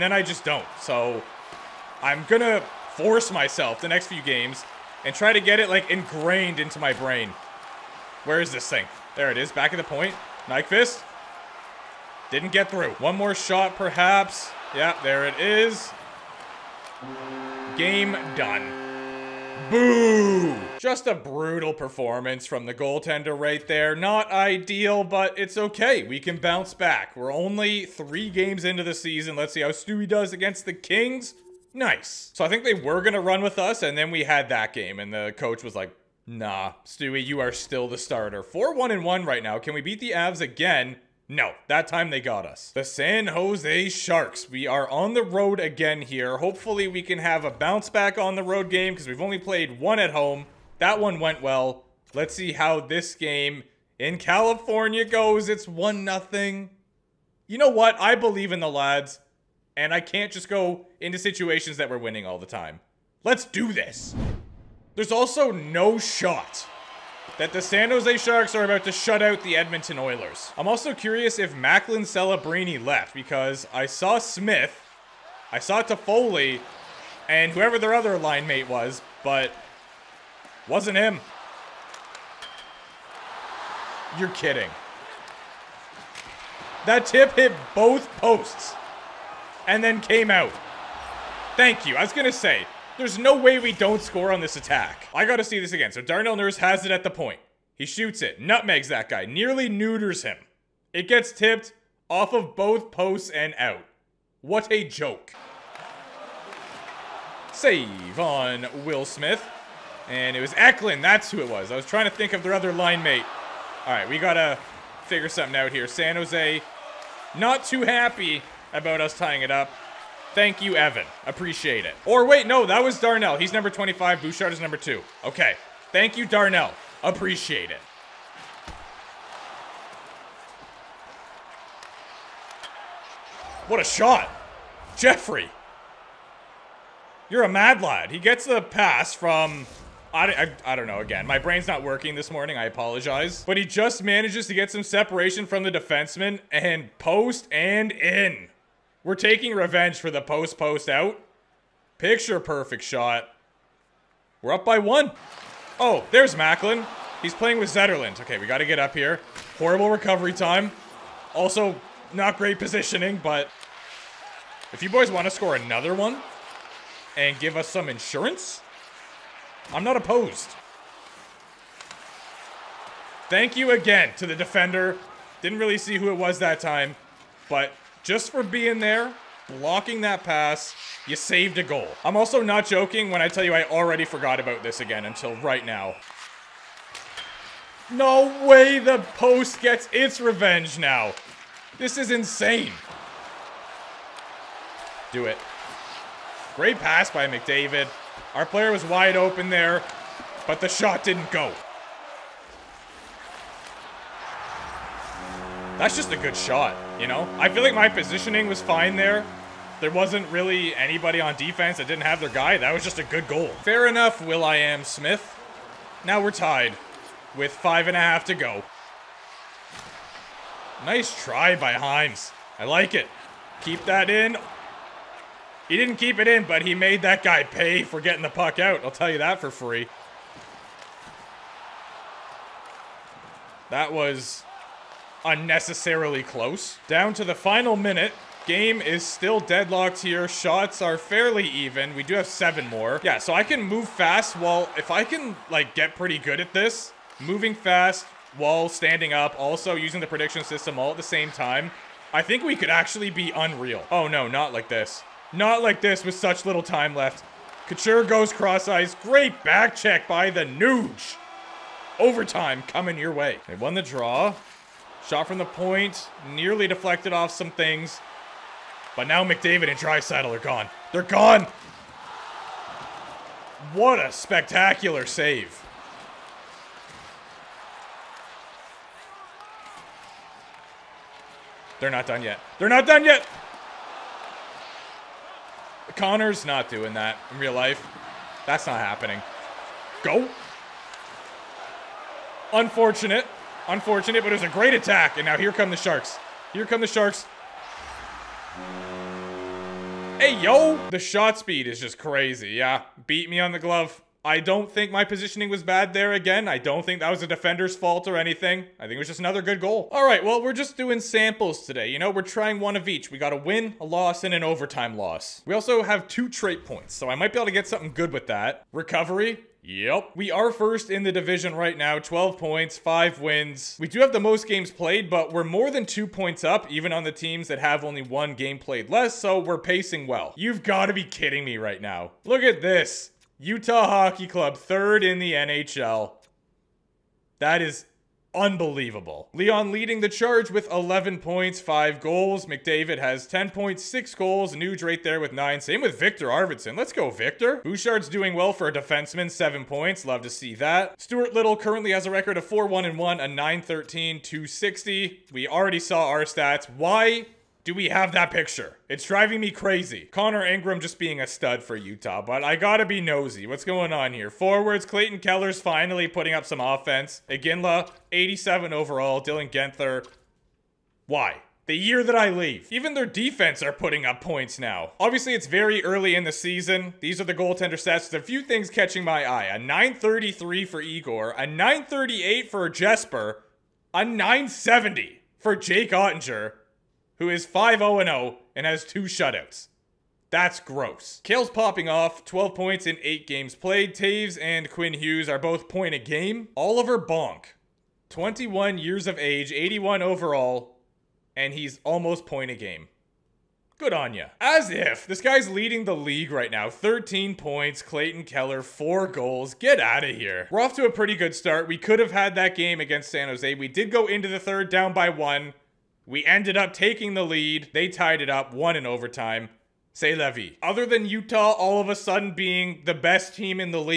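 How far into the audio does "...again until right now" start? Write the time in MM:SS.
03:04.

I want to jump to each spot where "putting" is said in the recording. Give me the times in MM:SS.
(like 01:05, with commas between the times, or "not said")
06:06, 06:13.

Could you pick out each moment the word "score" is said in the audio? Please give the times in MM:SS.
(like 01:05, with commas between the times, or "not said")
01:34, 02:45.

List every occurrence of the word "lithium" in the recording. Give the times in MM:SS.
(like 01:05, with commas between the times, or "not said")
not said.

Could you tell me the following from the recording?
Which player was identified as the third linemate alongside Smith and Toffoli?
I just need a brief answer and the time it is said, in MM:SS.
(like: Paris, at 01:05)
Eklund, at 01:50.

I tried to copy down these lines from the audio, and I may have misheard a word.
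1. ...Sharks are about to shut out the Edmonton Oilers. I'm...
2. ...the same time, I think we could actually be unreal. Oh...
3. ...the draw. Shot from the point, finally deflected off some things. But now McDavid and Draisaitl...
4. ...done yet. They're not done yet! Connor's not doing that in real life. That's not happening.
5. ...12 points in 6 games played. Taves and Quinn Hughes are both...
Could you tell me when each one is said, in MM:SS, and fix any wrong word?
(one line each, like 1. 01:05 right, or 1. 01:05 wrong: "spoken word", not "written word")
1. 01:08 right
2. 04:10 right
3. 04:23 wrong: "nearly", not "finally"
4. 04:42 right
5. 06:32 wrong: "8", not "6".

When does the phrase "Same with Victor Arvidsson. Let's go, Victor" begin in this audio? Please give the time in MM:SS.
05:45.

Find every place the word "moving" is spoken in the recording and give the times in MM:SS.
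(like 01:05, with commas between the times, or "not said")
04:07.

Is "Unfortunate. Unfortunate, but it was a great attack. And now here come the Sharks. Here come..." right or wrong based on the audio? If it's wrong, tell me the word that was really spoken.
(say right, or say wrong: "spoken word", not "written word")
right.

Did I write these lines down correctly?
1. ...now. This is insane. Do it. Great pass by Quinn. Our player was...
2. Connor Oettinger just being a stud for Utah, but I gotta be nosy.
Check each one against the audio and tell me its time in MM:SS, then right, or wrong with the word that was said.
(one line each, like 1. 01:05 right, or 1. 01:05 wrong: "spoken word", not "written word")
1. 03:10 wrong: "McDavid", not "Quinn"
2. 06:00 wrong: "Ingram", not "Oettinger".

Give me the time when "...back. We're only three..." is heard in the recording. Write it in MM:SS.
00:26.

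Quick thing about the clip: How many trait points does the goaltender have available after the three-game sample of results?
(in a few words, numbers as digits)
2.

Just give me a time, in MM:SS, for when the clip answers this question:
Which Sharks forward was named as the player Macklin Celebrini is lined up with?
02:37.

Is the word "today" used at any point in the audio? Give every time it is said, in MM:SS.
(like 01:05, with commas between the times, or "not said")
05:11.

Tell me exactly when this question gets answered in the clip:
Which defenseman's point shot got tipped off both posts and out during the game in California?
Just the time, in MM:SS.
01:36.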